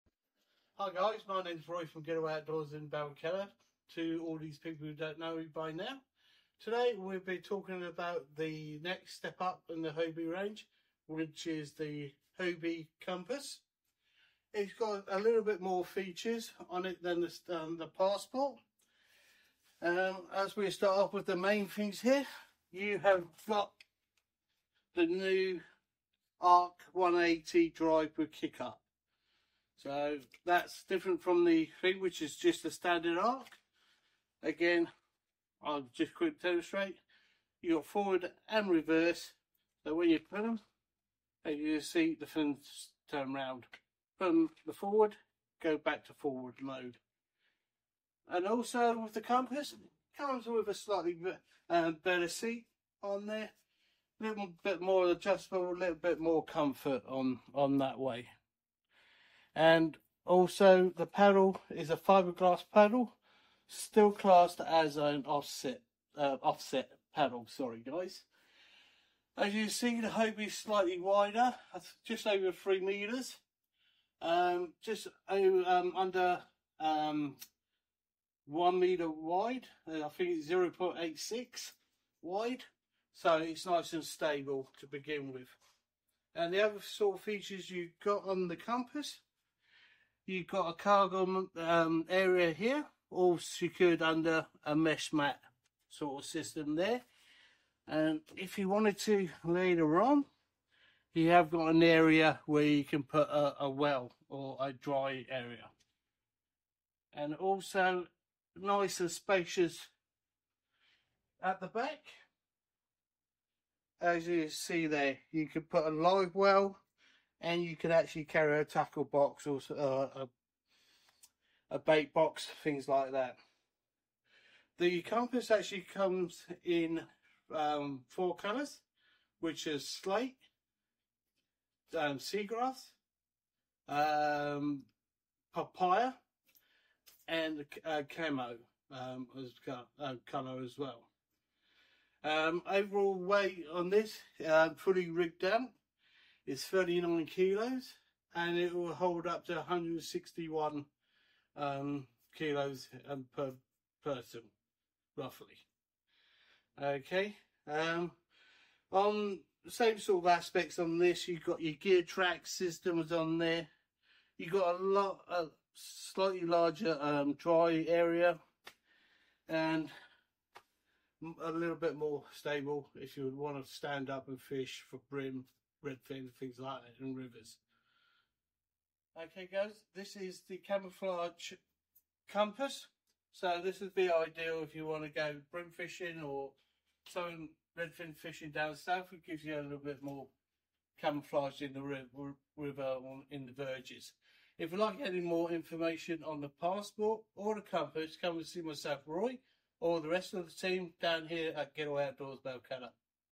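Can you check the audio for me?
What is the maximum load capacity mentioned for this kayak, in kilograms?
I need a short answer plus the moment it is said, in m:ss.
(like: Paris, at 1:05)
161 kilos, at 2:29.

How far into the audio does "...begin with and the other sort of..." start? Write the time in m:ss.
1:24.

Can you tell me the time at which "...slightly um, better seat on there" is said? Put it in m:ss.
0:50.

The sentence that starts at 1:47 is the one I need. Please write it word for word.
And also nice and spacious at the back.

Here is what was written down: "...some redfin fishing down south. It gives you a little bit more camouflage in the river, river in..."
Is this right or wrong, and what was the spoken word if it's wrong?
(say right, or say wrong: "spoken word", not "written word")
right.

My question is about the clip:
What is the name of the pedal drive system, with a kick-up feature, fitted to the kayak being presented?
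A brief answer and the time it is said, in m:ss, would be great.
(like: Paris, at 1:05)
Arc 180, at 0:26.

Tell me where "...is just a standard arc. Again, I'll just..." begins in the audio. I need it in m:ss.
0:32.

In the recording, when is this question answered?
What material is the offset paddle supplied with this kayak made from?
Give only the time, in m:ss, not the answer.
1:01.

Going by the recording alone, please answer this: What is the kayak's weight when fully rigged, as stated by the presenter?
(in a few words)
39 kilos.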